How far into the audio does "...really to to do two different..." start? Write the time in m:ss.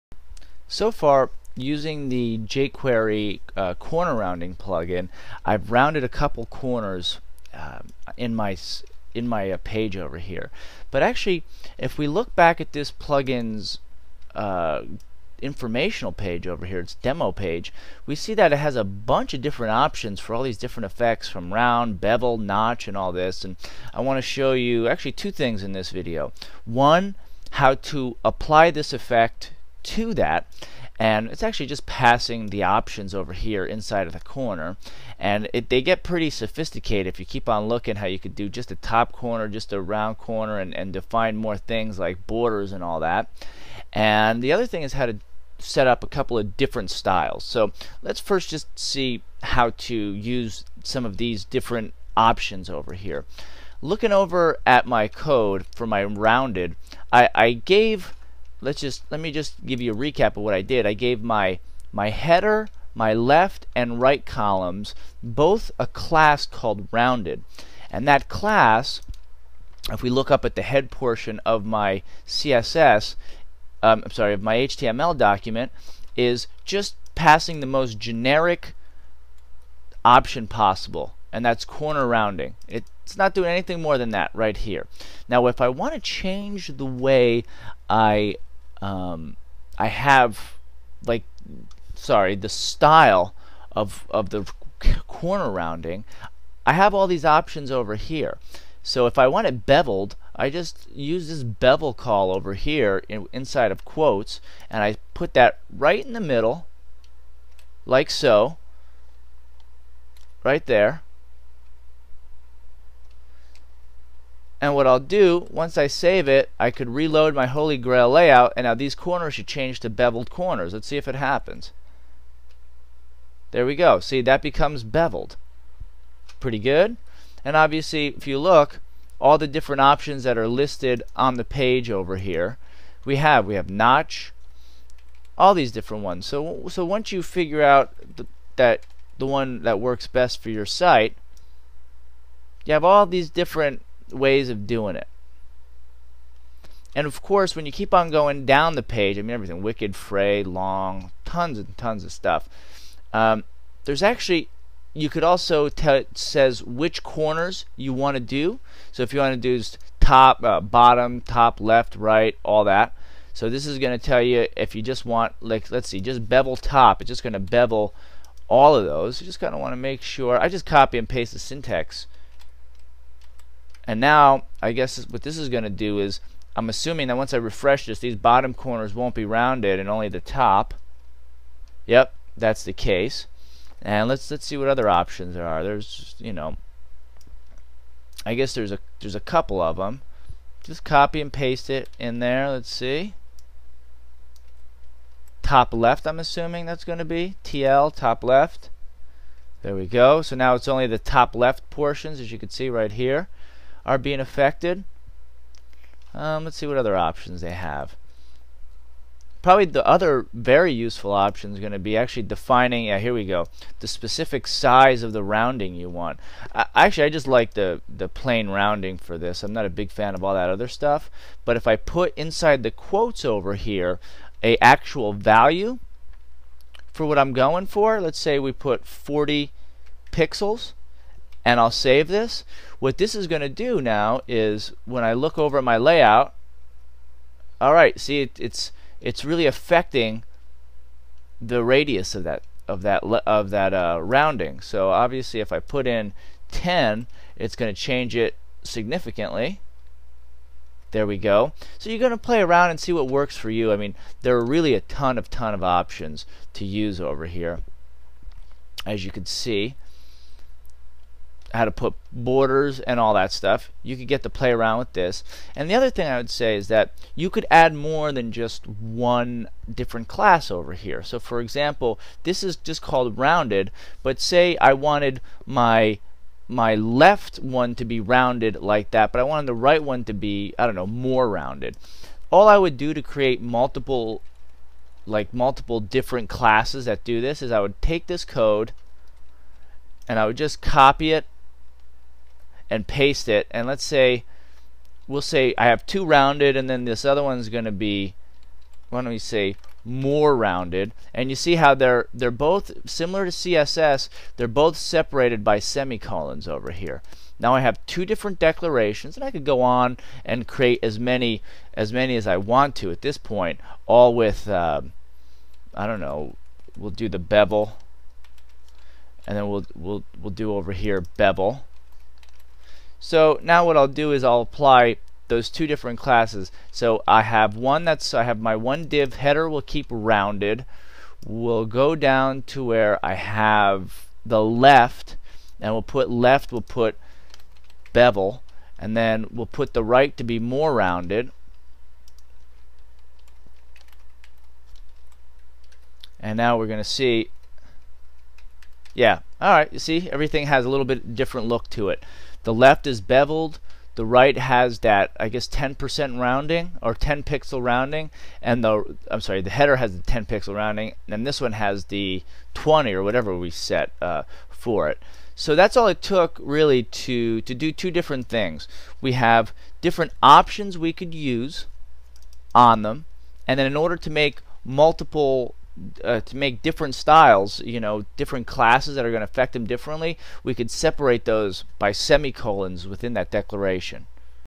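6:06.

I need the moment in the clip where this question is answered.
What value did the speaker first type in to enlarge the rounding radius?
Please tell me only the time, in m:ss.
3:48.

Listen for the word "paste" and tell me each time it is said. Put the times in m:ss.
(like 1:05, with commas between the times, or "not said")
2:51, 3:11, 4:52.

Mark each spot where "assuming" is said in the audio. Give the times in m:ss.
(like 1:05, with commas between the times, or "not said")
2:56, 3:16.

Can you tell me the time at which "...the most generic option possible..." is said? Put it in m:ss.
1:17.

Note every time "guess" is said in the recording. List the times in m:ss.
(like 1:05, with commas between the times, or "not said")
2:54, 3:08, 5:55.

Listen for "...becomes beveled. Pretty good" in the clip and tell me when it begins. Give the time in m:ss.
2:04.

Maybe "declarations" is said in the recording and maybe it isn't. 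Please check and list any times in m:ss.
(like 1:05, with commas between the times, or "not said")
5:08, 6:23.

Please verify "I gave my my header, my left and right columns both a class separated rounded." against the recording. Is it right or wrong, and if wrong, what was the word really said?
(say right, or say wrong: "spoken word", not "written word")
wrong: "called", not "separated".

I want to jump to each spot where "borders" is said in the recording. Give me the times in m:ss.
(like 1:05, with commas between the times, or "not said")
0:42, 4:22.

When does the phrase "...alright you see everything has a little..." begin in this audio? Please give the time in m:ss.
5:49.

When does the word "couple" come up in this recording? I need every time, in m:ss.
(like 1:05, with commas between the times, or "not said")
0:06, 0:46, 3:09.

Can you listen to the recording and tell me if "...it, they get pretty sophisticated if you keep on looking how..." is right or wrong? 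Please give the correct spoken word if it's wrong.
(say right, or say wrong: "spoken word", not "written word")
right.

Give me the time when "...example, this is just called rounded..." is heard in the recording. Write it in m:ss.
4:31.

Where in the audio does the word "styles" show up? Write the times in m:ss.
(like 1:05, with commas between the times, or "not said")
0:46, 1:32, 6:16.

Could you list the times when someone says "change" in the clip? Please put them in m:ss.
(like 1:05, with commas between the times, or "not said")
1:25, 1:59, 4:07.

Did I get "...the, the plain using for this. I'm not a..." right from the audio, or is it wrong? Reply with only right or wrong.
wrong.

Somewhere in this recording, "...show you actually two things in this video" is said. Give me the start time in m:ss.
0:24.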